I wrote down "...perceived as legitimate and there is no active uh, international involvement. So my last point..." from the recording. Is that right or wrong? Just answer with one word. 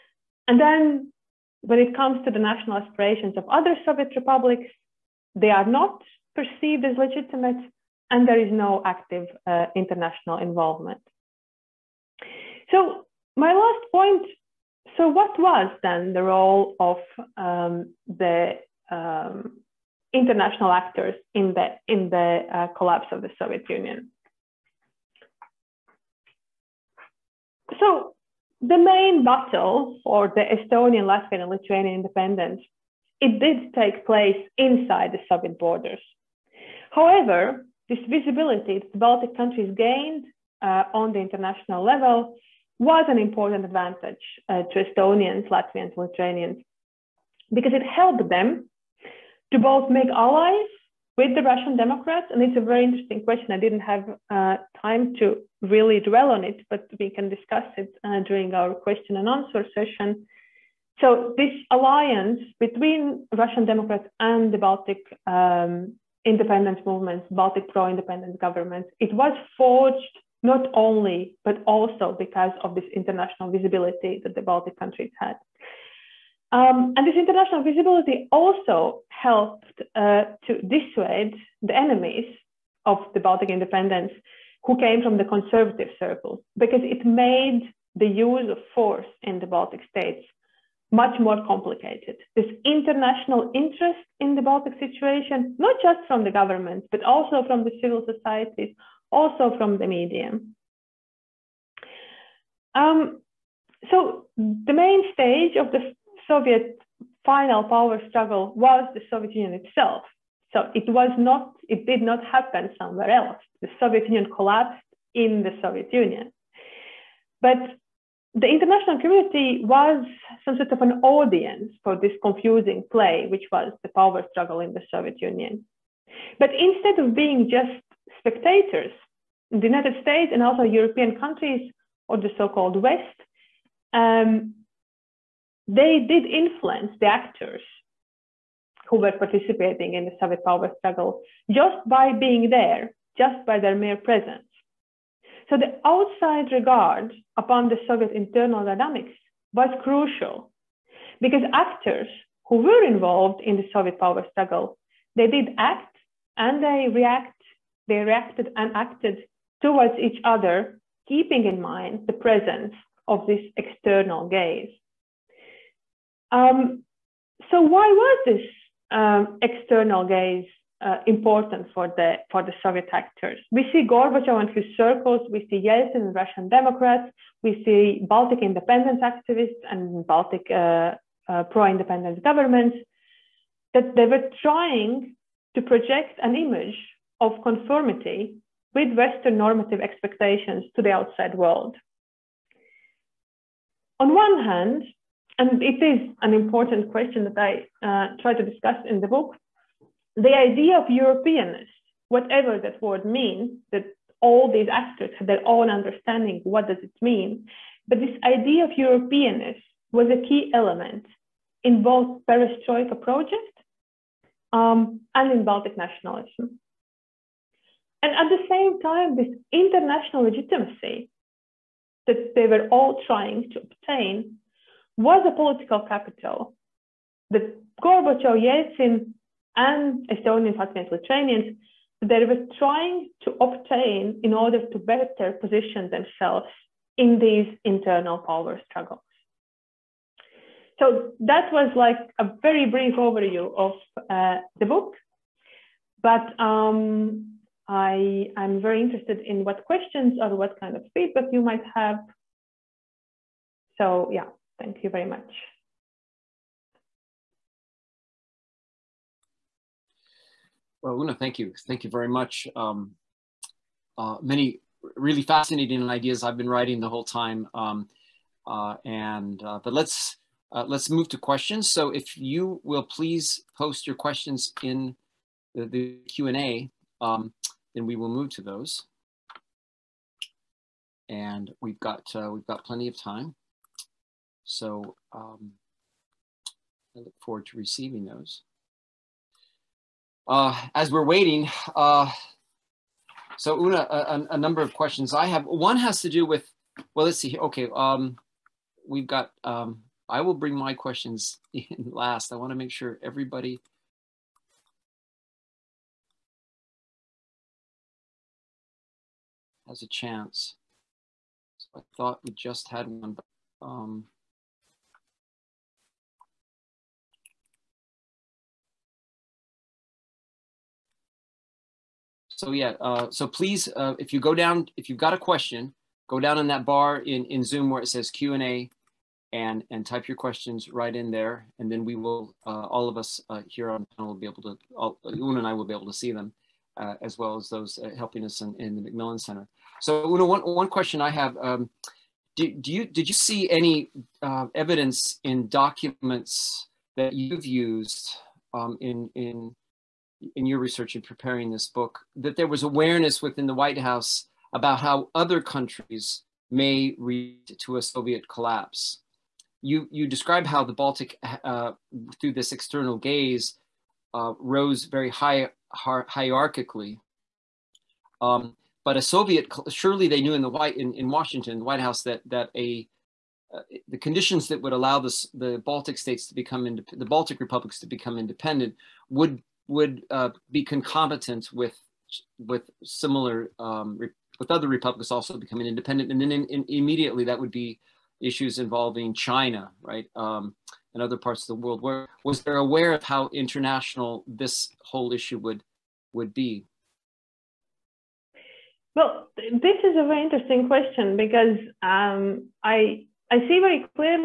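right.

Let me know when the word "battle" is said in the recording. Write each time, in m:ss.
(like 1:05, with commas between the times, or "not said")
0:29.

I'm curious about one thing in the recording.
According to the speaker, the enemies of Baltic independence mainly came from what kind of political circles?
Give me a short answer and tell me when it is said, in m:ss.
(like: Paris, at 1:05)
conservative circles, at 1:25.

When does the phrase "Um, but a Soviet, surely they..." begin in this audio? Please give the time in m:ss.
6:08.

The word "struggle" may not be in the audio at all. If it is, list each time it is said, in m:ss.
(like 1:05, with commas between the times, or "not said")
1:48, 2:04, 2:20, 2:34, 3:58.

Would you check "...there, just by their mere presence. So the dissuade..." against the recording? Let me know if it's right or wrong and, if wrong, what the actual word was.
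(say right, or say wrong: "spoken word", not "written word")
wrong: "outside", not "dissuade".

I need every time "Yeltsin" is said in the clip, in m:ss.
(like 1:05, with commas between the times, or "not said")
2:55, 3:48.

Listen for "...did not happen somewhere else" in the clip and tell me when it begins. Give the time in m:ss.
1:51.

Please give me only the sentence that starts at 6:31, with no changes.
Where was there aware of how international this whole issue would would be?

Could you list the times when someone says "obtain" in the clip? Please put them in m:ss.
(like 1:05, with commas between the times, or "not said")
3:43, 3:53.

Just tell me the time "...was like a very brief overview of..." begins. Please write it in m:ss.
4:01.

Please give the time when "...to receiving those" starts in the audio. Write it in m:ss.
4:47.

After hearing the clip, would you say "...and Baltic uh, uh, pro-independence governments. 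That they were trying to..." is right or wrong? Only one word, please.
right.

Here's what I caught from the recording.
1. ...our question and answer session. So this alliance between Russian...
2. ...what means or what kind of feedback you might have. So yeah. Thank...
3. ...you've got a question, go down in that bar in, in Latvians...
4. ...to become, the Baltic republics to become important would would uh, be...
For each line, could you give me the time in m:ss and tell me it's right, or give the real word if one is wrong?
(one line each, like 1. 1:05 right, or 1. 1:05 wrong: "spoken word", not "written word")
1. 0:58 right
2. 4:09 wrong: "questions", not "means"
3. 5:24 wrong: "Zoom", not "Latvians"
4. 6:16 wrong: "independent", not "important".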